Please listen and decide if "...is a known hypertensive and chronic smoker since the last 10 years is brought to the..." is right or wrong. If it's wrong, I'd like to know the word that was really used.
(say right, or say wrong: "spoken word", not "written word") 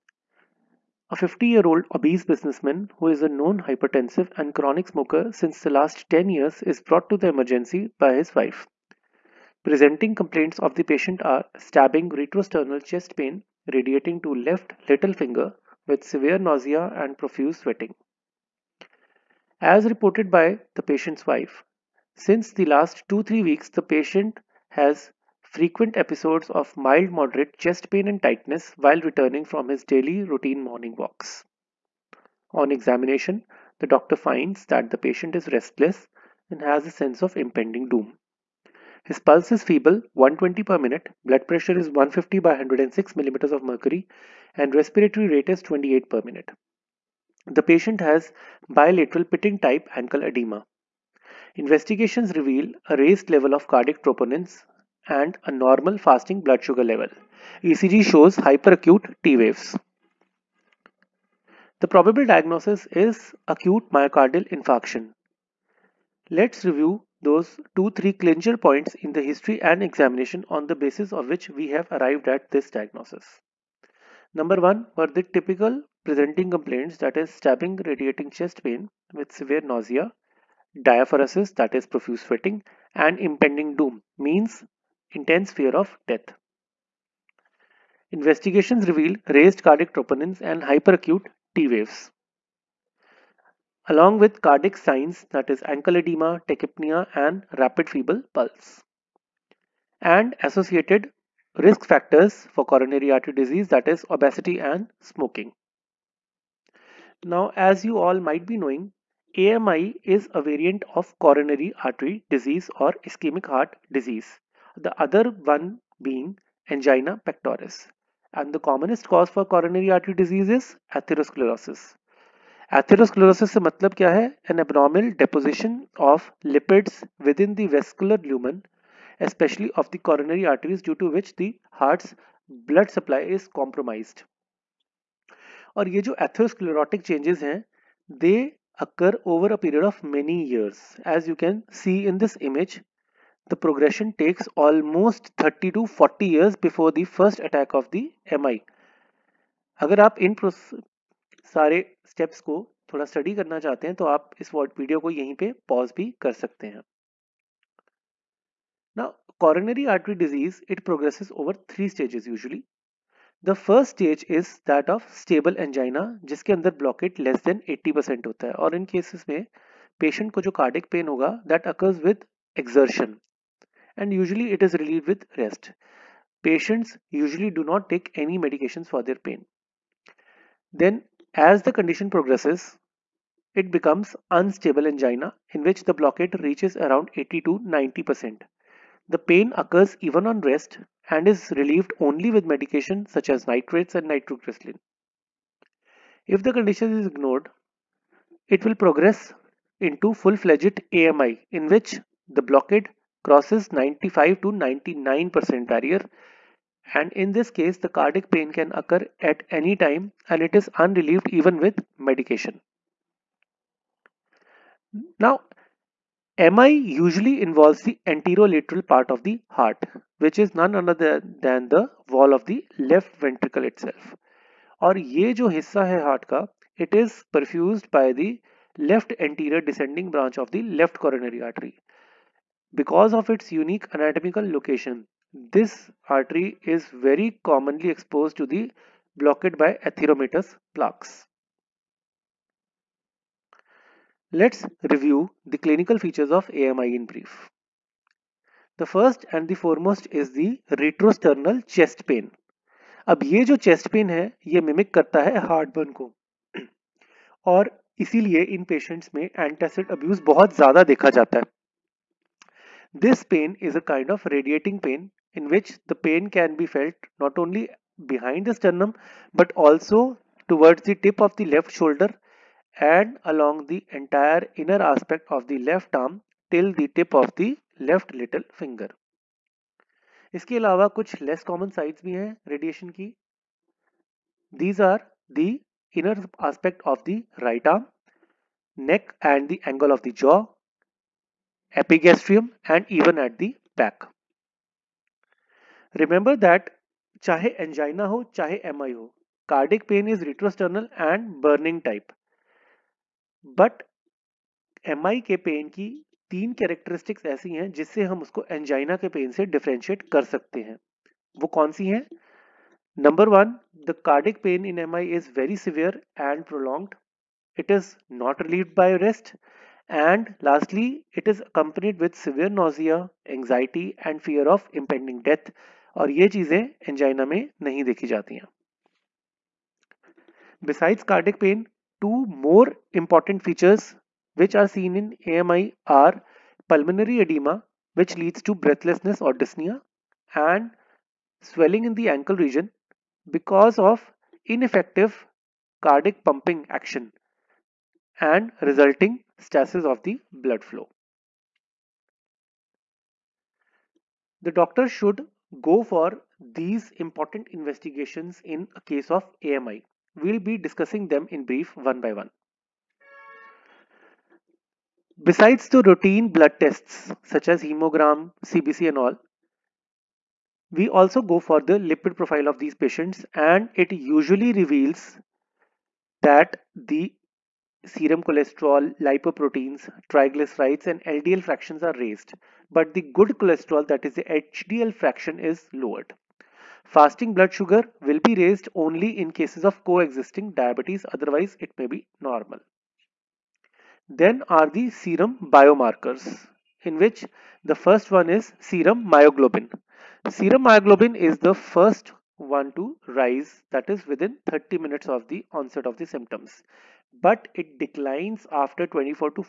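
right.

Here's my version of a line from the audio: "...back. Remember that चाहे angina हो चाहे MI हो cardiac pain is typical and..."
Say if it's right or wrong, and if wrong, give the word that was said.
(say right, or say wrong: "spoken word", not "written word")
wrong: "retrosternal", not "typical".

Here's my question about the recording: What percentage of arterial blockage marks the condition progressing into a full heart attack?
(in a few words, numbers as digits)
95 to 99%.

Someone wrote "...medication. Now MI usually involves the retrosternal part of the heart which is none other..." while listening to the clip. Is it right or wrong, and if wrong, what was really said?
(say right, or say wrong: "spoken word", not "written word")
wrong: "anterolateral", not "retrosternal".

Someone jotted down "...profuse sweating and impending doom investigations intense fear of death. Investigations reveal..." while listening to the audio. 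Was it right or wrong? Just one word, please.
wrong.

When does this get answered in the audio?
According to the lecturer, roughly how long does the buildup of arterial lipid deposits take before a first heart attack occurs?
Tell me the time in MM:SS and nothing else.
02:25.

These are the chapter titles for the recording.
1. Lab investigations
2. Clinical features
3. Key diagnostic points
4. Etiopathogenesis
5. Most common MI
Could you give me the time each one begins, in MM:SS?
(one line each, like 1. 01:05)
1. 05:51
2. 04:02
3. 01:00
4. 01:46
5. 03:32.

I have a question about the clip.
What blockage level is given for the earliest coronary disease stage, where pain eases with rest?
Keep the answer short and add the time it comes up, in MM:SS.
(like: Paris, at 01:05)
less than 80%, at 02:47.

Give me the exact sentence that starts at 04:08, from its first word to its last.
The first and the foremost is the retrosternal chest pain.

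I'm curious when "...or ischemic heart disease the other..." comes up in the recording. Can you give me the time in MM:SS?
01:52.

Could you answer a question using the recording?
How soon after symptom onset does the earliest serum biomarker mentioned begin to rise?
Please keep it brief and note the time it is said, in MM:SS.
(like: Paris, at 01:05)
within 30 minutes, at 06:44.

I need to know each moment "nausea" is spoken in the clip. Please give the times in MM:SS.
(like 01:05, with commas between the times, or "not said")
00:16, 01:19, 05:22.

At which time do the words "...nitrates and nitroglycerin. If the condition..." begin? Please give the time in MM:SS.
03:13.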